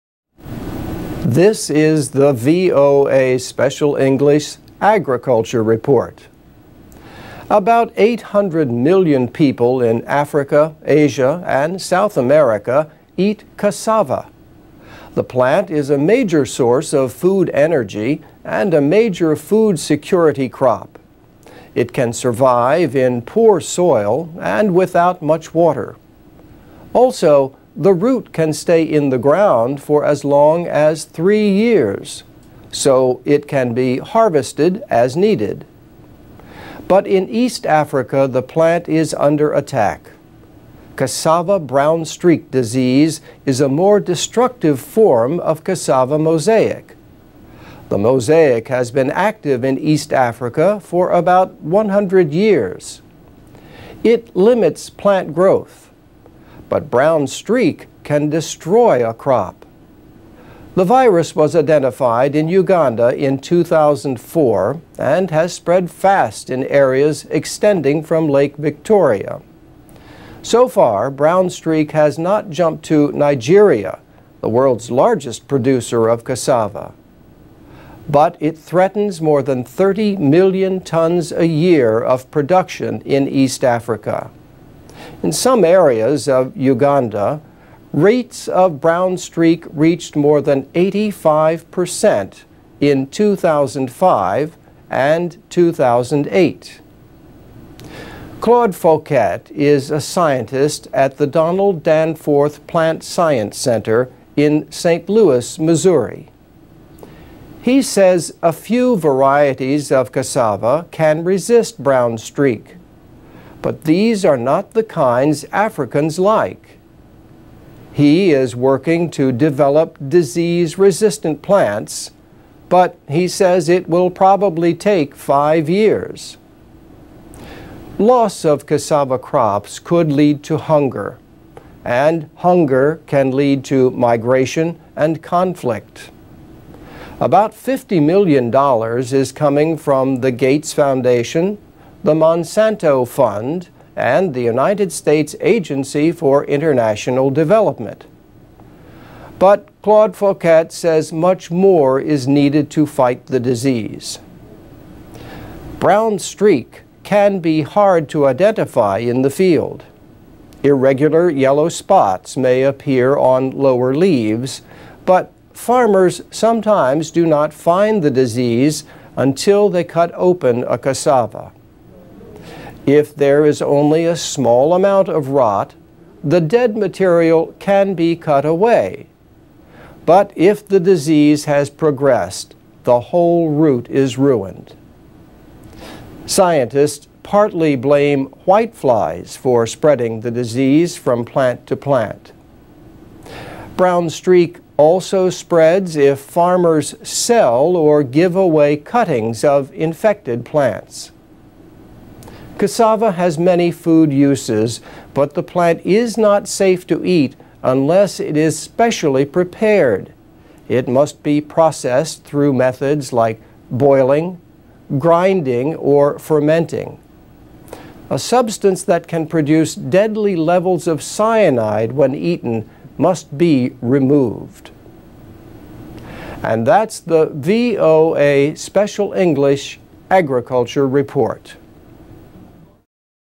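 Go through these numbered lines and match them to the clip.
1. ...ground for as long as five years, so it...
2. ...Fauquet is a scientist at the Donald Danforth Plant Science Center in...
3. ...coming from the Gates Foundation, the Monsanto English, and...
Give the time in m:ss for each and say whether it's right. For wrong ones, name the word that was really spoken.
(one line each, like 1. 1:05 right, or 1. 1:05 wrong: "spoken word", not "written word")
1. 0:29 wrong: "three", not "five"
2. 1:38 right
3. 2:19 wrong: "Fund", not "English".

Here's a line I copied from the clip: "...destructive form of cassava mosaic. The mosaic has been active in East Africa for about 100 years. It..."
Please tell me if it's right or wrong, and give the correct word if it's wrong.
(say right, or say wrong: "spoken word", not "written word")
right.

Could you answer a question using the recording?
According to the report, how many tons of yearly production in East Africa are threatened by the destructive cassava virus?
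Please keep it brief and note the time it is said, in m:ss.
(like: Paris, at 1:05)
more than 30 million tons, at 1:19.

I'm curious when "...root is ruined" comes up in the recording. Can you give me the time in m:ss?
3:03.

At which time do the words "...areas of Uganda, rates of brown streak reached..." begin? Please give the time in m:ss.
1:25.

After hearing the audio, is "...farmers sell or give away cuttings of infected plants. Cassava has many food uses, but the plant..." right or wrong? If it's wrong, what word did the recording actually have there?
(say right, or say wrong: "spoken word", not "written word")
right.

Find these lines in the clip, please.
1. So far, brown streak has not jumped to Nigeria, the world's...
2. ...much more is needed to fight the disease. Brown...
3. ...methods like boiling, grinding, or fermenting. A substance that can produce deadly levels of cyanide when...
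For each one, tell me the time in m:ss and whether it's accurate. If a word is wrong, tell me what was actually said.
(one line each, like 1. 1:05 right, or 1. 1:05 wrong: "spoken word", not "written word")
1. 1:10 right
2. 2:31 right
3. 3:32 right.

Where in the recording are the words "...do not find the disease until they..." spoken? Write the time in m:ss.
2:47.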